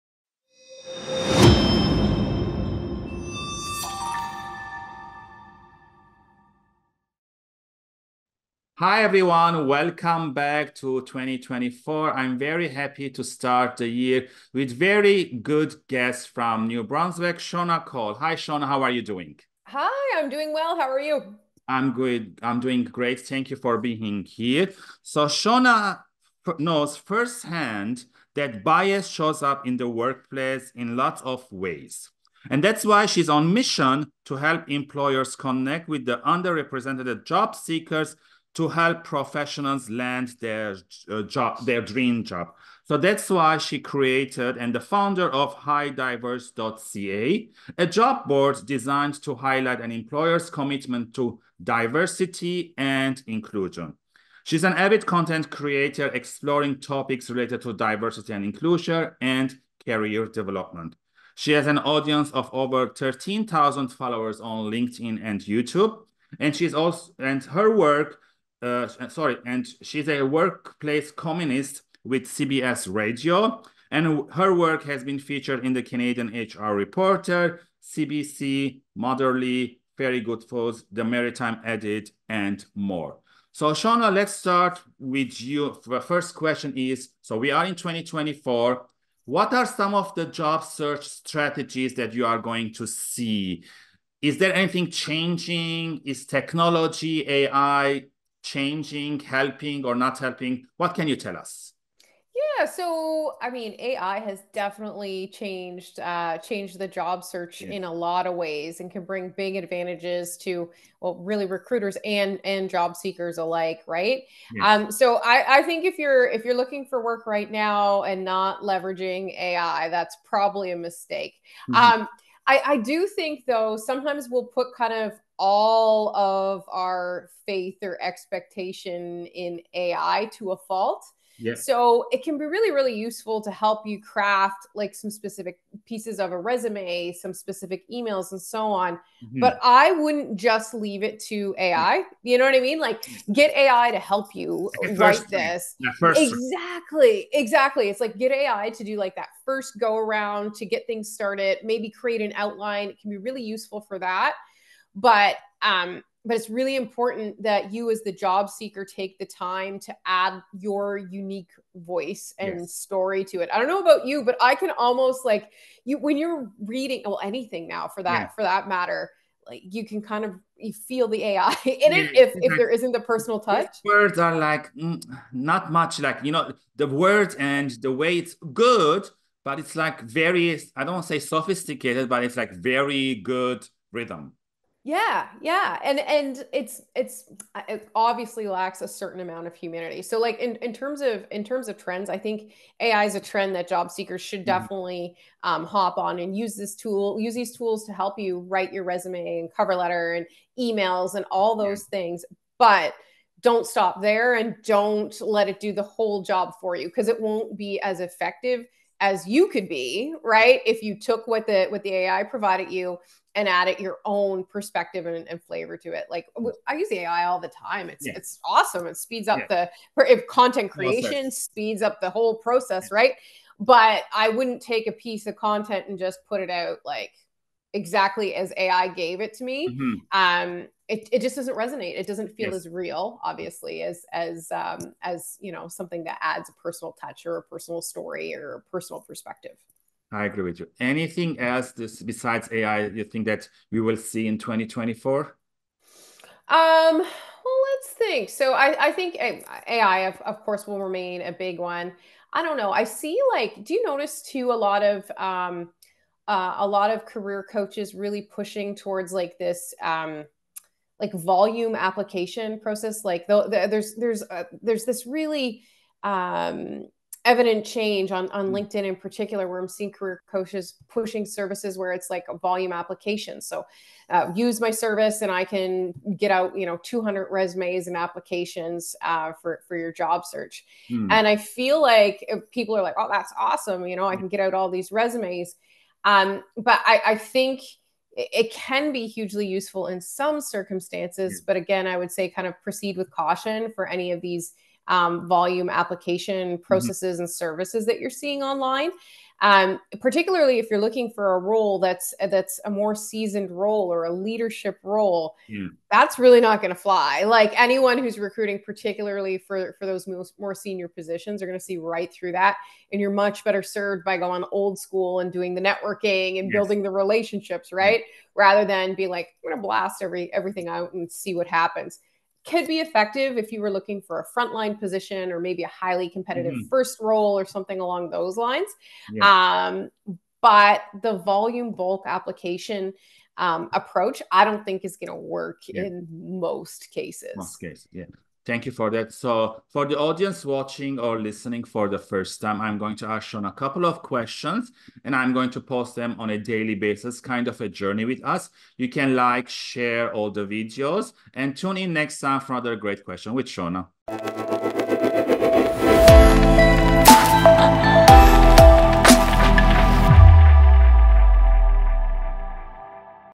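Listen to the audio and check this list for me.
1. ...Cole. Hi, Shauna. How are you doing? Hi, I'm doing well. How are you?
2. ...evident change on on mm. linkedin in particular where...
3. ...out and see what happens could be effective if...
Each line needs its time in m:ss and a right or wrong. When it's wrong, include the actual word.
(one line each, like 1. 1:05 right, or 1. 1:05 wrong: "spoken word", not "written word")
1. 0:17 right
2. 4:27 right
3. 5:20 right.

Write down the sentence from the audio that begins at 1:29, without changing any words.
What are some of the job search strategies that you are going to see?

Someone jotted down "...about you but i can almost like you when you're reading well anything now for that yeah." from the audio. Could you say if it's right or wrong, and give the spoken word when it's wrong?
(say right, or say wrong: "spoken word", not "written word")
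right.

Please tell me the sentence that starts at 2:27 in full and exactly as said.
It's like get AI to do like that first go around to get things started, maybe create an outline.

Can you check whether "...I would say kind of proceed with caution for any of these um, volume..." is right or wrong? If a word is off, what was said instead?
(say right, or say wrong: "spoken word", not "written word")
right.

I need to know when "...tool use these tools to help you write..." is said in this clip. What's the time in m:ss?
3:16.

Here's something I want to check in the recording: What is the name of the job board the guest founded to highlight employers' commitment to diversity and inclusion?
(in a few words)
hirediverse.ca.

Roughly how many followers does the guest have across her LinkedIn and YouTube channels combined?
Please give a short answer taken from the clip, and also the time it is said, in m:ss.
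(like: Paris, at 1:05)
13,000, at 1:02.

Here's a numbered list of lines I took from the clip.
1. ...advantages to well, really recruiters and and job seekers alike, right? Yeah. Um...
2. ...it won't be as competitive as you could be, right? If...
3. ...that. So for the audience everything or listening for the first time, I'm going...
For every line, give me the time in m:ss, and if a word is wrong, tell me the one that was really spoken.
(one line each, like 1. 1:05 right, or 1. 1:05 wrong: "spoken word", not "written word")
1. 1:49 right
2. 3:27 wrong: "effective", not "competitive"
3. 5:38 wrong: "watching", not "everything".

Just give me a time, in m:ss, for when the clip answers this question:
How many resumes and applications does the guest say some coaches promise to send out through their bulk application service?
4:36.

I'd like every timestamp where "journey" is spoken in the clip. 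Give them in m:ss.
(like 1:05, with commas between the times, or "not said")
5:47.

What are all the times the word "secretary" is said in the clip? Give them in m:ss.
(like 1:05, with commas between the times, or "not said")
not said.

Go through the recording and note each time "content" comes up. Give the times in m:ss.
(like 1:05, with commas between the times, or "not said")
0:55, 3:40, 3:45.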